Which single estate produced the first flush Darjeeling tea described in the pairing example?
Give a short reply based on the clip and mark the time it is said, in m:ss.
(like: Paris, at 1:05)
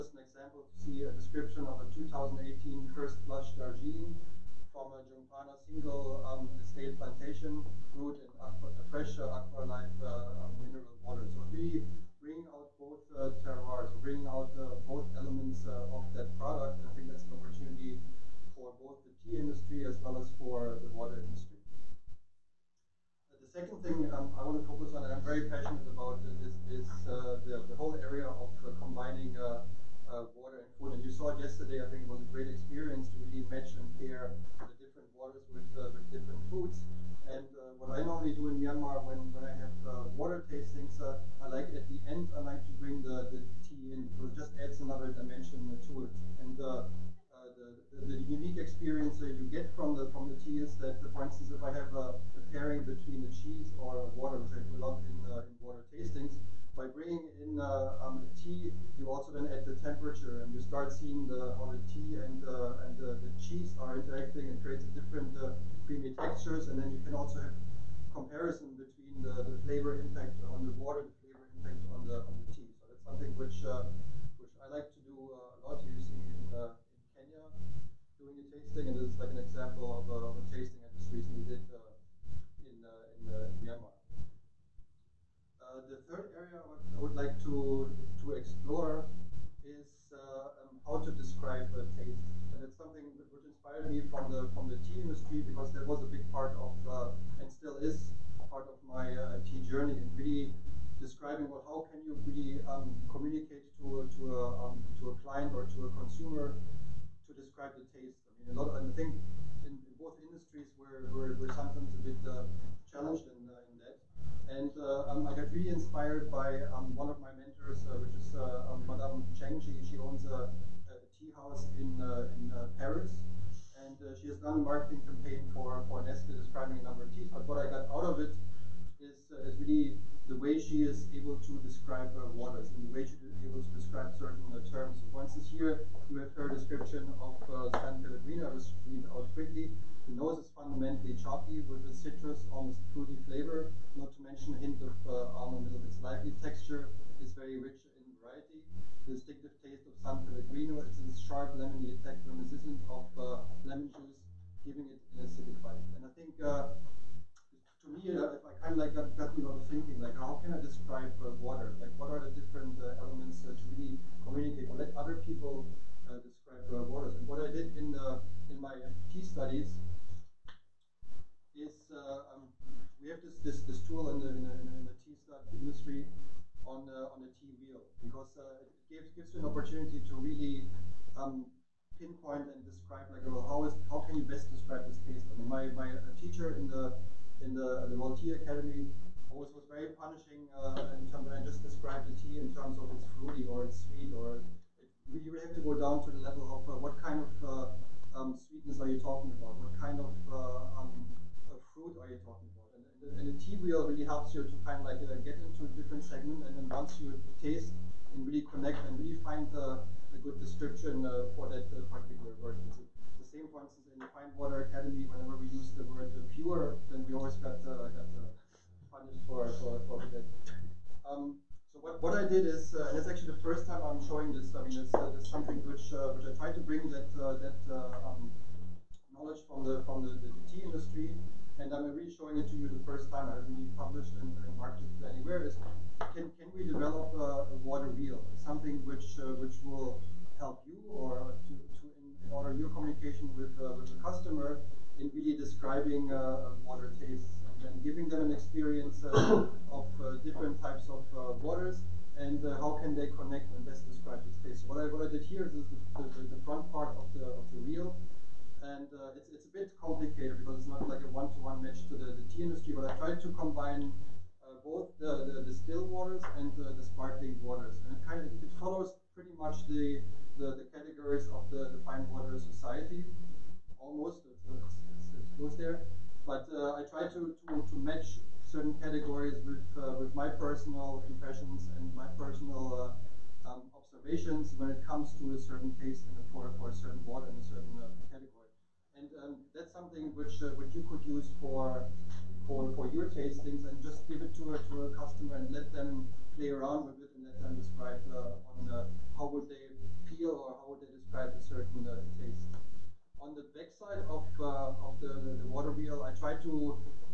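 Jungpana, at 0:05.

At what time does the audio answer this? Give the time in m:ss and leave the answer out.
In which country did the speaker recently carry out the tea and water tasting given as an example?
1:23.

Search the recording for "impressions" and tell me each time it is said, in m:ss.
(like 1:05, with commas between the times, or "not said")
4:41.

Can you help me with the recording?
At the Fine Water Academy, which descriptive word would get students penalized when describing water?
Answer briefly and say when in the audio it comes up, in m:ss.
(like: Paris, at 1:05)
pure, at 3:36.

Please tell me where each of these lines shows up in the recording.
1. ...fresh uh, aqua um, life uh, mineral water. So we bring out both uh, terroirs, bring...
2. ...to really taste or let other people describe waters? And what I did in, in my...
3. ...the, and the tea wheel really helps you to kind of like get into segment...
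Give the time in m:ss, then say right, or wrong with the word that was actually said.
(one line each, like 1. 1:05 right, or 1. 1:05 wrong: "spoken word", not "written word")
1. 0:08 right
2. 2:43 wrong: "communicate", not "taste"
3. 3:23 right.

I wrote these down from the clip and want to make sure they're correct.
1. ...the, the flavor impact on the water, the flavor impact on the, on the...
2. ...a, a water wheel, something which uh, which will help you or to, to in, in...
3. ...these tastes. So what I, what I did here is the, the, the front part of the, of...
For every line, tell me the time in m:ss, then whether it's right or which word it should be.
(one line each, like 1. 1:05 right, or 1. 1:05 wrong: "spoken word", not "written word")
1. 1:09 right
2. 3:57 right
3. 4:14 right.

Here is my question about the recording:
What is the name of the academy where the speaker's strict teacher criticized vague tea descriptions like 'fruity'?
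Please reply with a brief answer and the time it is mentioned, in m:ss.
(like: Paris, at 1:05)
Voltaire Academy, at 3:07.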